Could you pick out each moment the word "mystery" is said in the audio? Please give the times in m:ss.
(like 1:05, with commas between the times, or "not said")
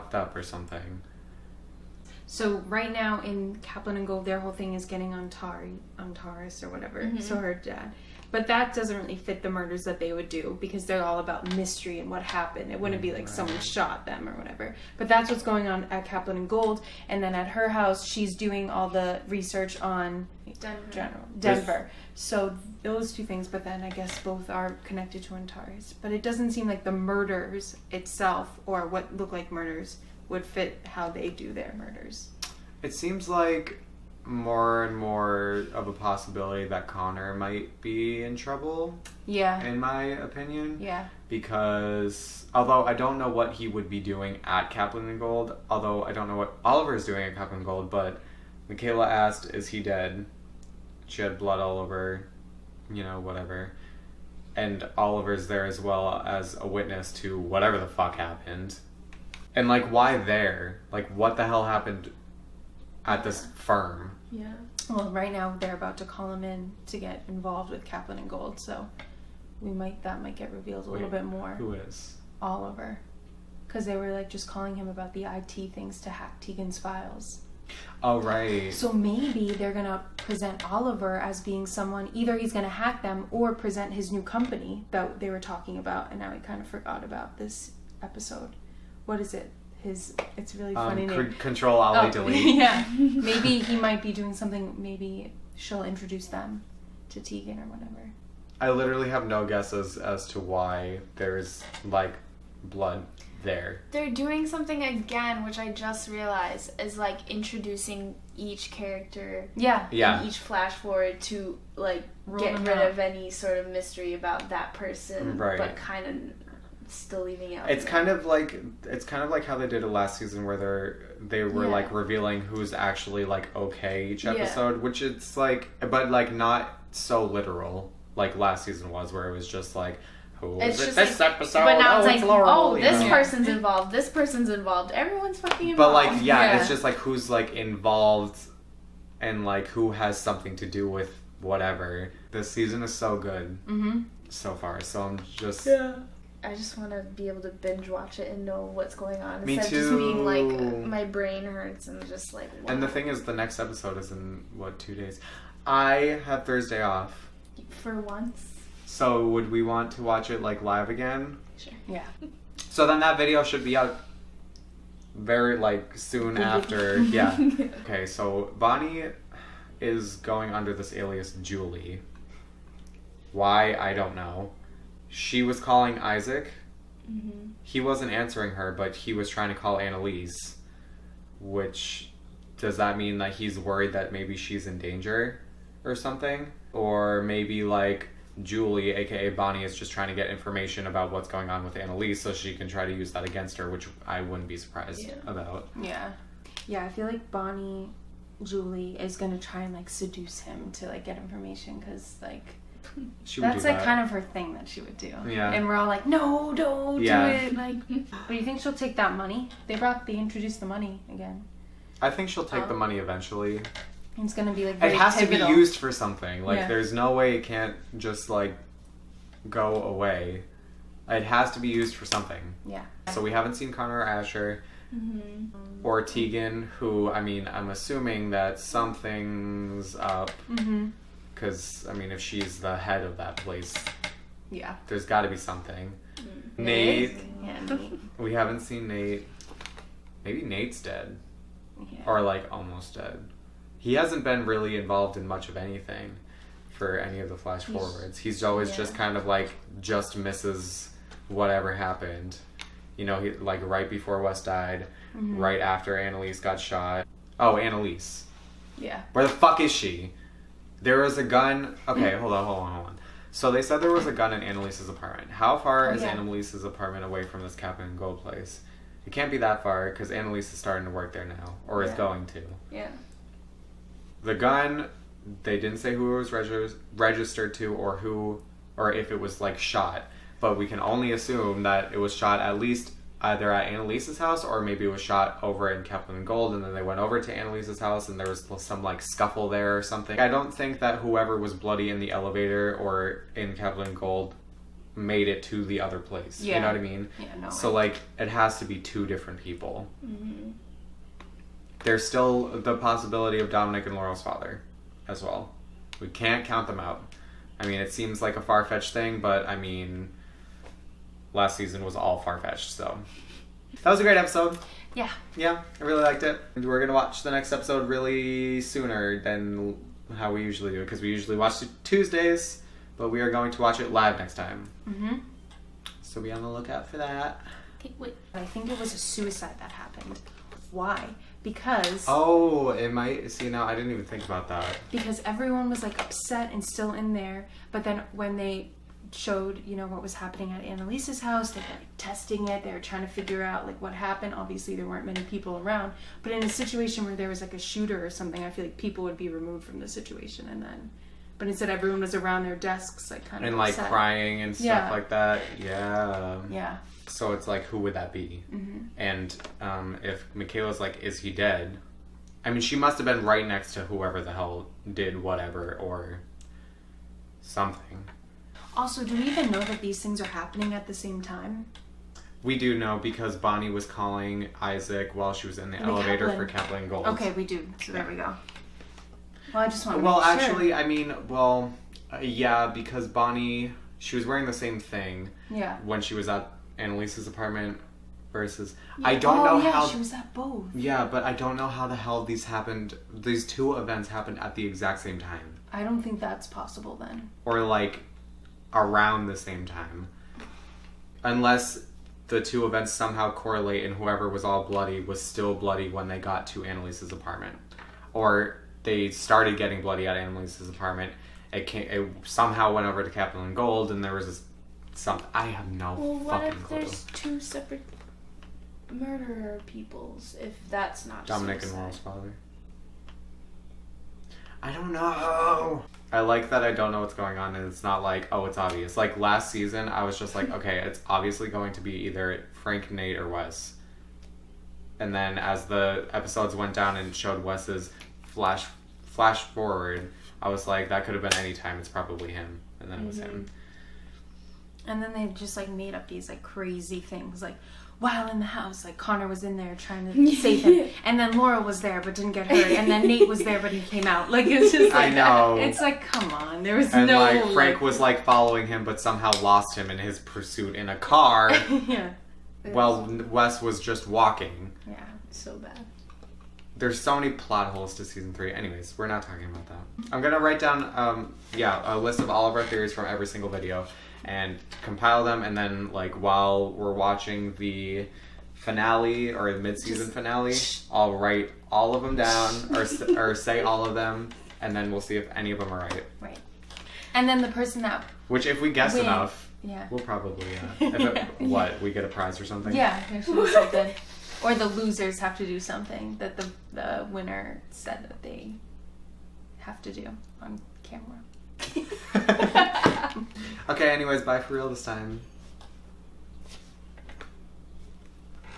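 0:11, 1:53.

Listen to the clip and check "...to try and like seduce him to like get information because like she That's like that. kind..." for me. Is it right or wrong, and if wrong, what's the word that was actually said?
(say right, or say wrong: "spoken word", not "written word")
right.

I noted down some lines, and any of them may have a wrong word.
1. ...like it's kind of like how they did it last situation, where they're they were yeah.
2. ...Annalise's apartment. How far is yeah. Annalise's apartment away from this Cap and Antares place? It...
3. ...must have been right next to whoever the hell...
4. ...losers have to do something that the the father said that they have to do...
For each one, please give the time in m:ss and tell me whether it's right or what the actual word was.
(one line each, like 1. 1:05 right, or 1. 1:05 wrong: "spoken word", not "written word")
1. 1:58 wrong: "season", not "situation"
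2. 4:24 wrong: "Gold", not "Antares"
3. 6:02 right
4. 8:14 wrong: "winner", not "father".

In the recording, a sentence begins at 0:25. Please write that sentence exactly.
But it doesn't seem like the murders itself or what look like murders would fit how they do their murders.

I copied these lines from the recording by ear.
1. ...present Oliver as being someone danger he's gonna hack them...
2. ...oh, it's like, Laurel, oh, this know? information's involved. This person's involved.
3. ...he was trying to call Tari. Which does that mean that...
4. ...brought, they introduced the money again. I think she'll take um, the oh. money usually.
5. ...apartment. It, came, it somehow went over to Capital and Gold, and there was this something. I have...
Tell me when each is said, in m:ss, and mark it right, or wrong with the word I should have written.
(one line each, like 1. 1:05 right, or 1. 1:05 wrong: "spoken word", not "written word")
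1. 1:20 wrong: "either", not "danger"
2. 2:11 wrong: "person", not "information"
3. 2:58 wrong: "Annalise", not "Tari"
4. 3:29 wrong: "eventually", not "usually"
5. 6:50 right.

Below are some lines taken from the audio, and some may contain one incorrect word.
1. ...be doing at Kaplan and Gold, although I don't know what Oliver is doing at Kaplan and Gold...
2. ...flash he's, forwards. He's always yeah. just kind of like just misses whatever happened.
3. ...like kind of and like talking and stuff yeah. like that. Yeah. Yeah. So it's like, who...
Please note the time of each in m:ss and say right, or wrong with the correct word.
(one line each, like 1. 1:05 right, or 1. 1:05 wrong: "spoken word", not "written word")
1. 0:43 right
2. 4:07 right
3. 5:53 wrong: "crying", not "talking".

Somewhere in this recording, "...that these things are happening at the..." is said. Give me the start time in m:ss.
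6:09.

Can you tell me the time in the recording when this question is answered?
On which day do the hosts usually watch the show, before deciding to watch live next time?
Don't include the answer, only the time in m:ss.
5:21.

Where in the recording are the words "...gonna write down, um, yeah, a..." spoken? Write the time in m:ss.
7:50.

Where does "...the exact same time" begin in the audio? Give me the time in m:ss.
6:34.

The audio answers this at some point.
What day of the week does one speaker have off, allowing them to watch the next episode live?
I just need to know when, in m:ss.
2:36.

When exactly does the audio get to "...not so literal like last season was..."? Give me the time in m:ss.
2:06.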